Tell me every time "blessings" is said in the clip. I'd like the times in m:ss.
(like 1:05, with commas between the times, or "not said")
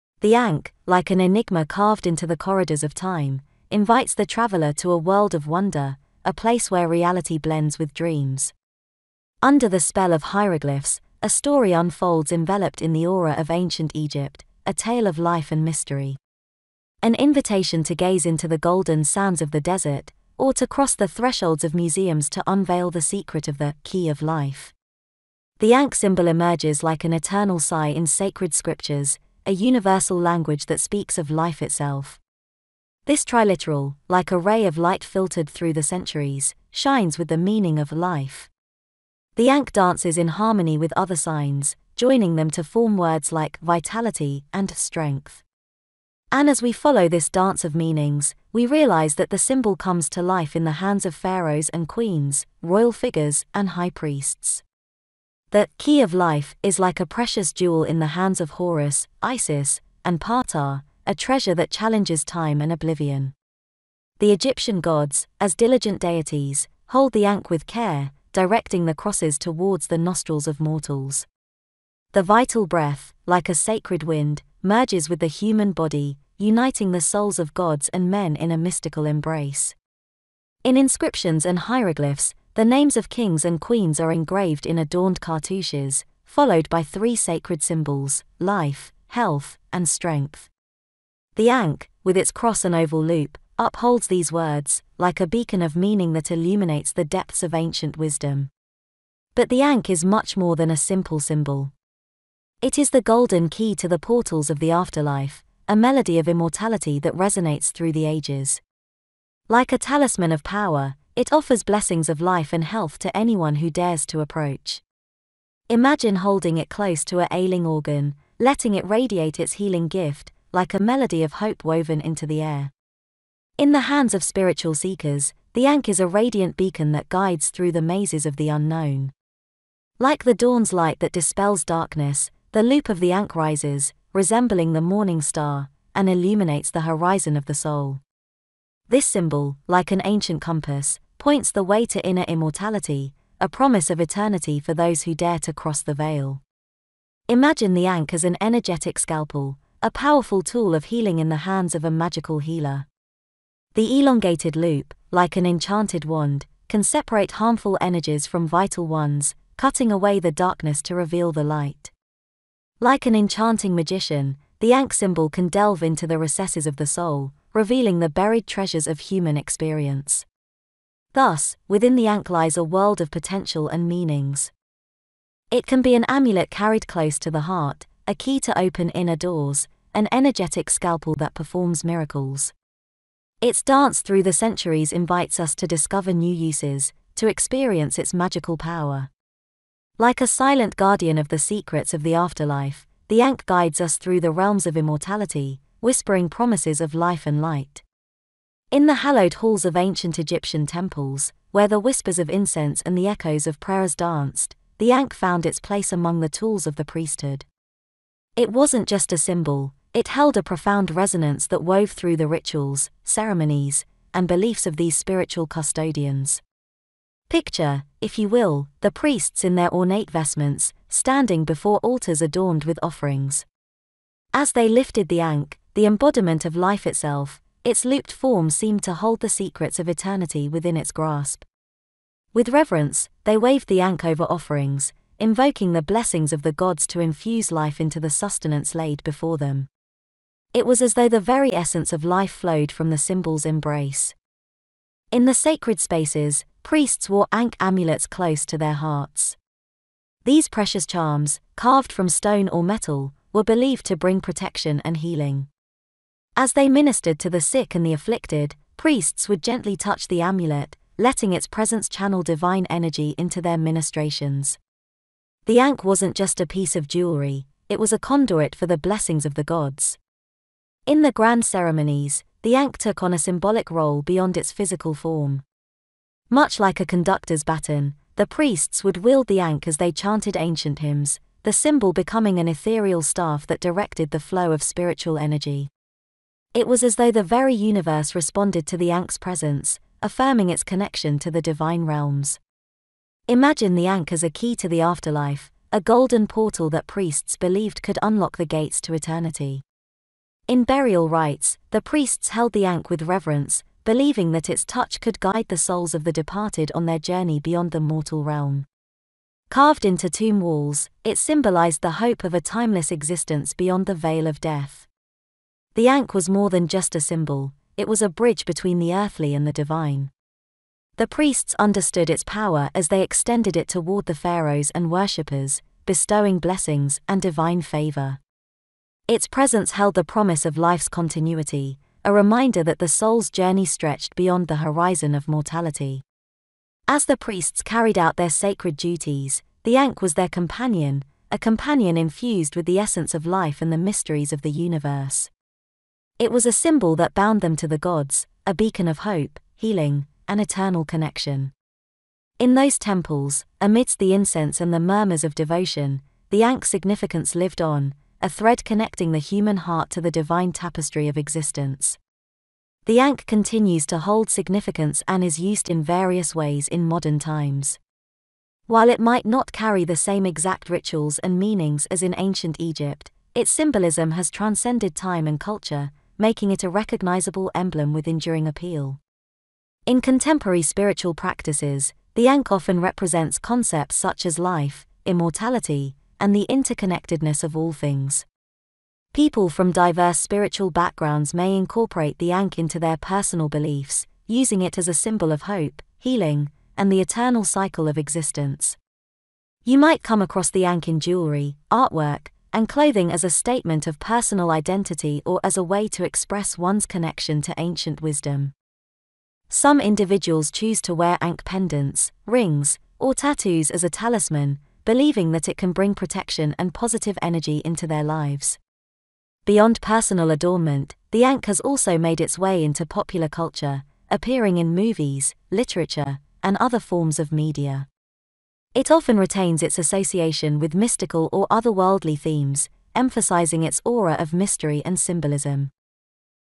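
1:51, 3:55, 4:28, 5:26.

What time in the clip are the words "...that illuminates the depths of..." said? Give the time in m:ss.
1:36.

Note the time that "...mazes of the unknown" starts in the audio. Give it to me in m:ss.
2:07.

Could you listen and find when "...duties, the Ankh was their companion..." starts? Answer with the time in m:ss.
5:38.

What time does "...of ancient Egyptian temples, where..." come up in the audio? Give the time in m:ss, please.
3:19.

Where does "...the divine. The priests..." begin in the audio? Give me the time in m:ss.
5:19.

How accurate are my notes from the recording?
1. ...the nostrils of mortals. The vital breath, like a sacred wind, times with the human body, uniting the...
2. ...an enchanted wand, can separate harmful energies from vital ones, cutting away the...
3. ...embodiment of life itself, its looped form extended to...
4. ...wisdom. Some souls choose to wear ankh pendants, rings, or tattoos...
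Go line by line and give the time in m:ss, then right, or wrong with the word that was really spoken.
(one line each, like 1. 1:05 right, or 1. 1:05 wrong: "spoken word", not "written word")
1. 1:09 wrong: "merges", not "times"
2. 2:35 right
3. 3:45 wrong: "seemed", not "extended"
4. 6:48 wrong: "individuals", not "souls".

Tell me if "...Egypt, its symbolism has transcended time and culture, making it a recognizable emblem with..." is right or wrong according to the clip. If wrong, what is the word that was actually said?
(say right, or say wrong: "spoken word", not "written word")
right.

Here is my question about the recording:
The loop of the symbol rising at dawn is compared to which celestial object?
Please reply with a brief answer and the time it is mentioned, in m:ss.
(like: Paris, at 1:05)
the morning star, at 2:14.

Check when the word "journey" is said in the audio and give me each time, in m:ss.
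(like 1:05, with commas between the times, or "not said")
5:06, 5:33.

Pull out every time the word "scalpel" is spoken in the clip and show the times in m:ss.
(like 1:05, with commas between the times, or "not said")
2:28, 3:00.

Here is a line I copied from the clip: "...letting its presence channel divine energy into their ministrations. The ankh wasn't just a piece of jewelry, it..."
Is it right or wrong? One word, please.
right.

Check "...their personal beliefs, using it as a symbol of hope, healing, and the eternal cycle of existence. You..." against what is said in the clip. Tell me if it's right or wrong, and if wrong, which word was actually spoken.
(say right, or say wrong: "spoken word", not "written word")
right.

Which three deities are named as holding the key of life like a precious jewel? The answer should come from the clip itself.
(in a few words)
Horus, Isis, and Ptah.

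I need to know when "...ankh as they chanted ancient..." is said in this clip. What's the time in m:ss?
4:39.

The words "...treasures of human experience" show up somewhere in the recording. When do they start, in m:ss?
2:48.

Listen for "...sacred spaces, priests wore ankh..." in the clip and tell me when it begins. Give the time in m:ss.
4:05.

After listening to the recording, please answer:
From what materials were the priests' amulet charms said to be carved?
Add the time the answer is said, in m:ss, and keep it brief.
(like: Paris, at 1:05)
stone or metal, at 4:12.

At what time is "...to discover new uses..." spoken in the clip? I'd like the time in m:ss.
3:05.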